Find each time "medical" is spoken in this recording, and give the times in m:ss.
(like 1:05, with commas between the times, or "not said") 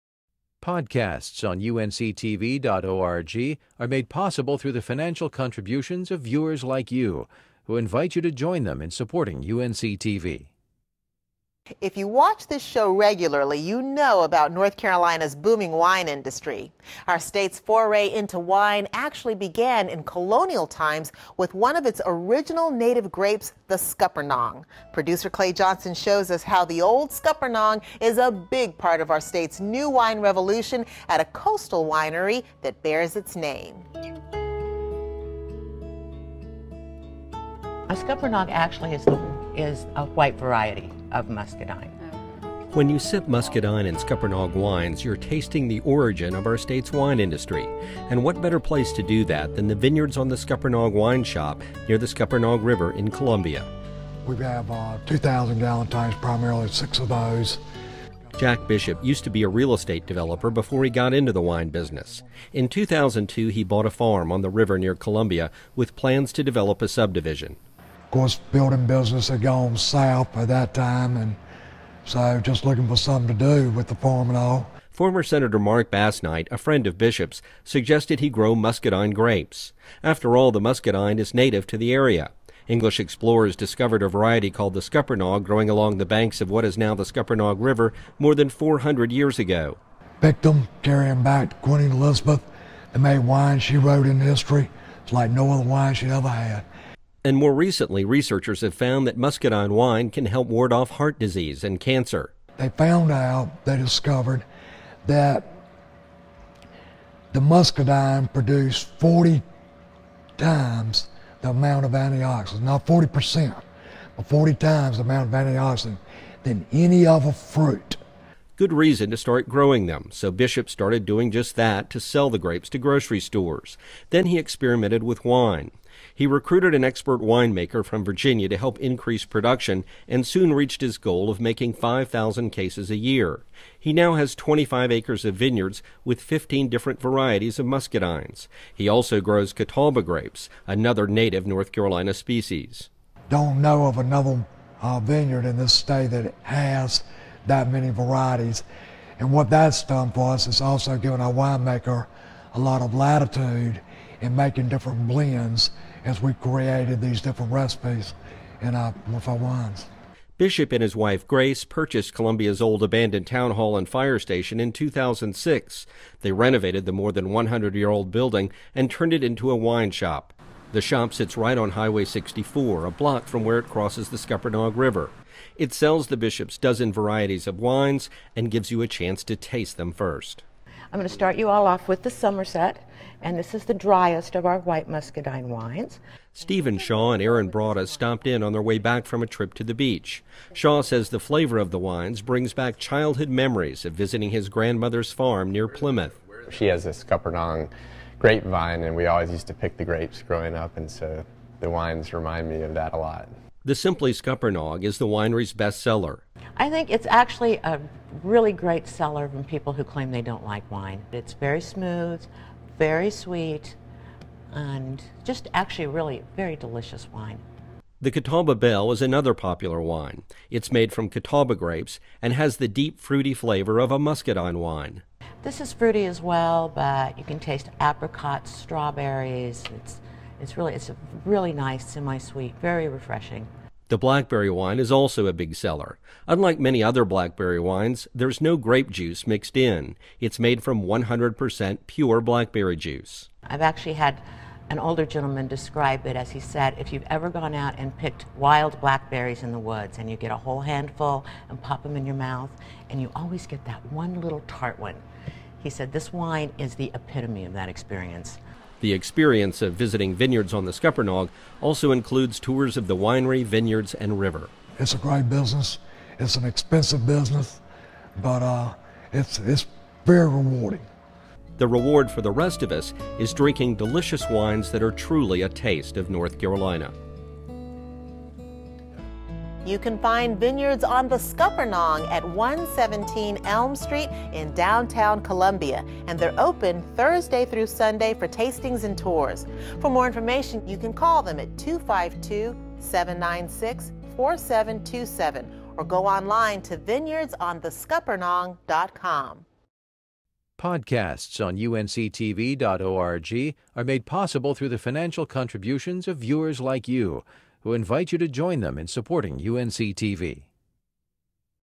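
not said.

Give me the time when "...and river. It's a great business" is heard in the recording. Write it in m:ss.
4:23.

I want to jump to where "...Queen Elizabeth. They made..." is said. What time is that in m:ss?
1:31.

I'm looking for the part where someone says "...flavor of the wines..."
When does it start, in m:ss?
3:11.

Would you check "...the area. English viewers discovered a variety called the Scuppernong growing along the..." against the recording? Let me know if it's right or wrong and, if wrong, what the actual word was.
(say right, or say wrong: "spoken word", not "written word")
wrong: "explorers", not "viewers".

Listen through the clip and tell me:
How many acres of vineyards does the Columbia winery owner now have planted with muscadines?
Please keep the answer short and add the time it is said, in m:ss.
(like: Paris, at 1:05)
25 acres, at 2:14.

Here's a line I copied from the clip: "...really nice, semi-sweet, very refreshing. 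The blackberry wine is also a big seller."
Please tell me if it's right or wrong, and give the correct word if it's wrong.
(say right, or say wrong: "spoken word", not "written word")
right.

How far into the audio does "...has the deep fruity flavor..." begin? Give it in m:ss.
3:42.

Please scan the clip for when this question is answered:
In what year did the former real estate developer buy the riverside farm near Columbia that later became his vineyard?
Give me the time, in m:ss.
1:02.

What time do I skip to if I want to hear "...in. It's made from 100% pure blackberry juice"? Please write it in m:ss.
3:59.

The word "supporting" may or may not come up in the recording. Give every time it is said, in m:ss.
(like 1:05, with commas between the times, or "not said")
0:08, 5:08.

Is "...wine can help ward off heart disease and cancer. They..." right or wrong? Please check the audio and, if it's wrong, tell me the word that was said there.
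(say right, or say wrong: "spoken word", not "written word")
right.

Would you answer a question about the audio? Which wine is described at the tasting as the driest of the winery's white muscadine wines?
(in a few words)
Somerset.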